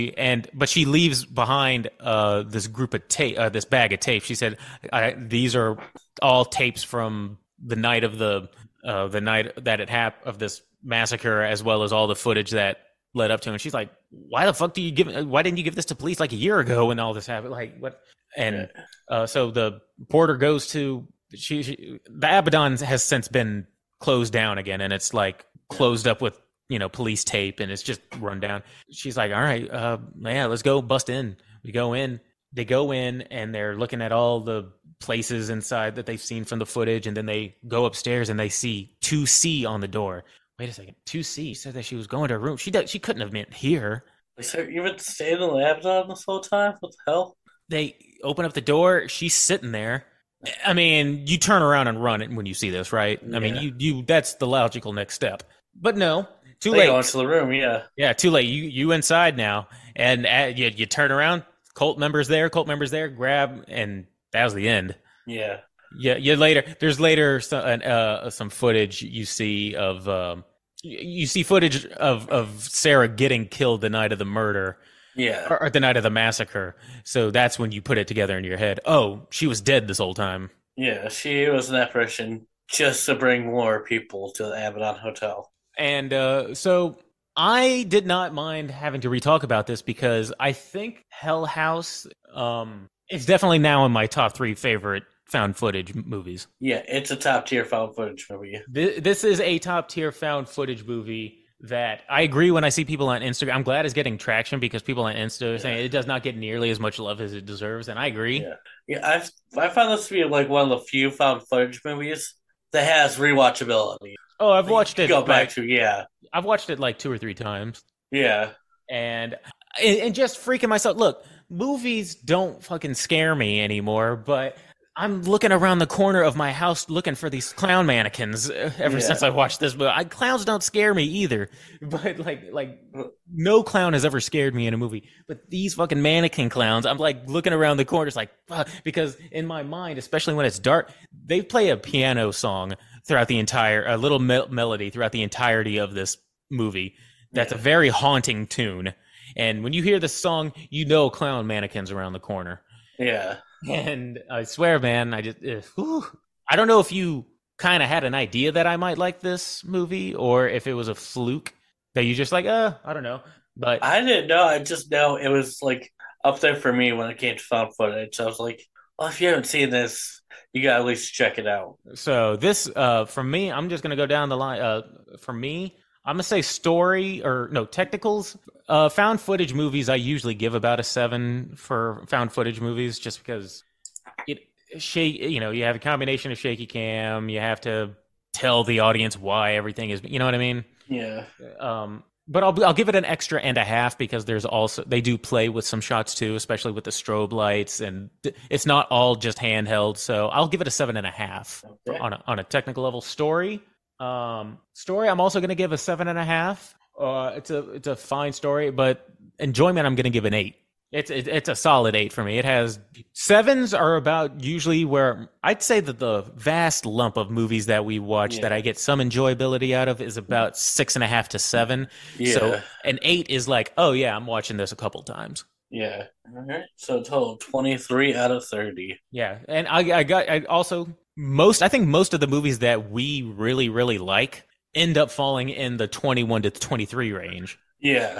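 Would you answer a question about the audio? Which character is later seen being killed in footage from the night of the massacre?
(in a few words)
Sarah.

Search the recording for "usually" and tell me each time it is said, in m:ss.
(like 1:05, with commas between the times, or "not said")
2:59, 3:34.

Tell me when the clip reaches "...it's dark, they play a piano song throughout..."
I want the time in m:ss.
2:20.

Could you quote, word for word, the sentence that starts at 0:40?
Wait a second, 2C said that she was going to her room.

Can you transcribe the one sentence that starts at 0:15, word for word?
Why didn't you give this to police like a year ago when all this happened?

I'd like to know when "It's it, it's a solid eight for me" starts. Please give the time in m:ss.
3:30.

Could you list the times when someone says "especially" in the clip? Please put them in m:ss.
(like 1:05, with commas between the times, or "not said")
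2:19, 3:16.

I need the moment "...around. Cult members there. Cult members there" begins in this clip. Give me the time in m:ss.
1:01.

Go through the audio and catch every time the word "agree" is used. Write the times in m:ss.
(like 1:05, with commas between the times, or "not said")
1:42, 1:48.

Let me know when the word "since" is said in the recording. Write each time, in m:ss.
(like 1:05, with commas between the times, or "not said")
0:23, 2:09.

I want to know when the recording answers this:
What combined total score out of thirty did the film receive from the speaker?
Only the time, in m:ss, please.
3:47.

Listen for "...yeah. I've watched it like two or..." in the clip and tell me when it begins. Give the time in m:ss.
1:55.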